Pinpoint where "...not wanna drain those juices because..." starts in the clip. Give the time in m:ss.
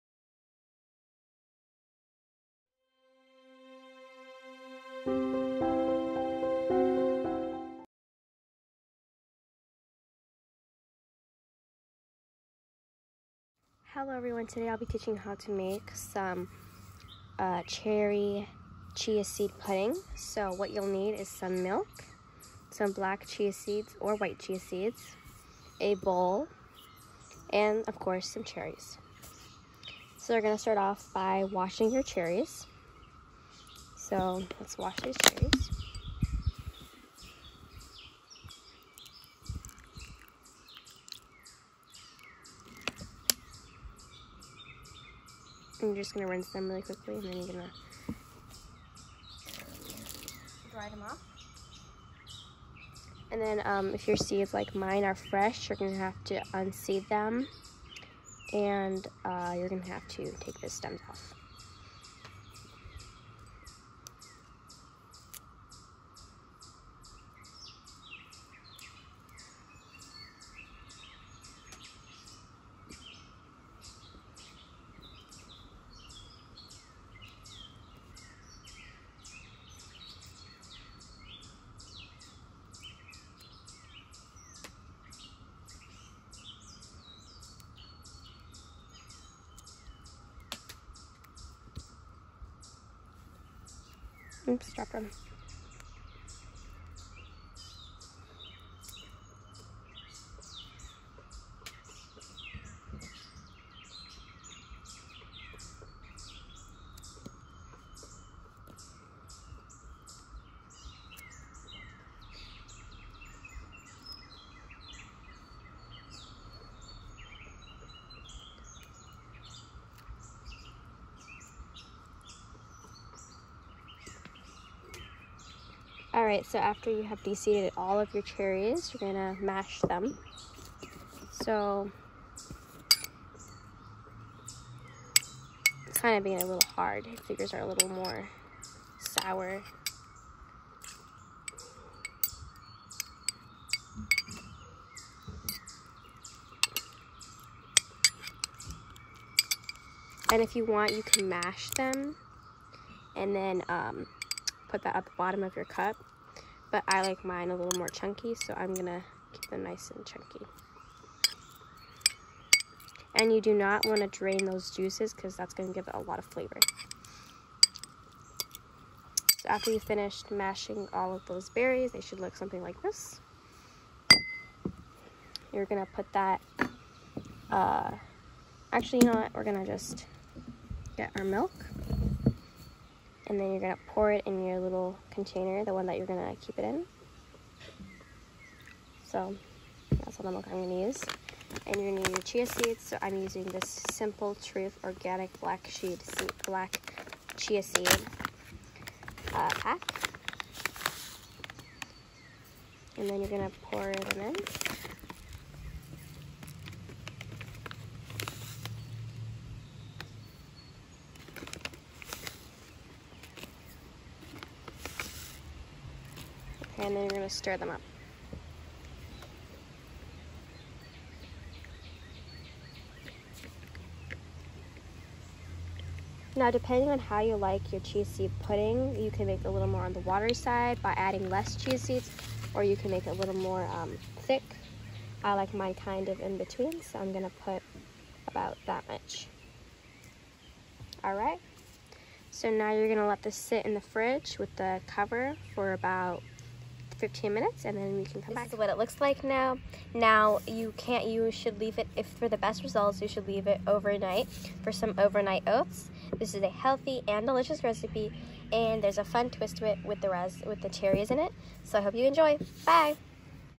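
2:43.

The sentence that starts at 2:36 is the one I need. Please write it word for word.
But I like mine a little more chunky, so I'm gonna keep them nice and chunky.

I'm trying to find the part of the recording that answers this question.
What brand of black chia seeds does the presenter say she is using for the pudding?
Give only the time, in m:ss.
3:13.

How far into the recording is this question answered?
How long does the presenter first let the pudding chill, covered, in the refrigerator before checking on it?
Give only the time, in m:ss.
4:07.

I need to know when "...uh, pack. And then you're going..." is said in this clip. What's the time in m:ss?
3:19.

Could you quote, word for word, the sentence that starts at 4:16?
This is a healthy and delicious recipe and there's a fun twist to it with the, res, with the cherries in it.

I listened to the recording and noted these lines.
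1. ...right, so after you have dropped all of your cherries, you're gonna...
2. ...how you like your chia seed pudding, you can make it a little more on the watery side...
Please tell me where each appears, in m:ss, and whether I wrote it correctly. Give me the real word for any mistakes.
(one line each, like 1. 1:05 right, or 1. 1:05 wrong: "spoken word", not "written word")
1. 2:06 wrong: "deseeded", not "dropped"
2. 3:46 right.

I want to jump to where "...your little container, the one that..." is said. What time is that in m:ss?
3:04.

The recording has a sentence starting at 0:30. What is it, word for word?
So we're going to start off by washing your cherries.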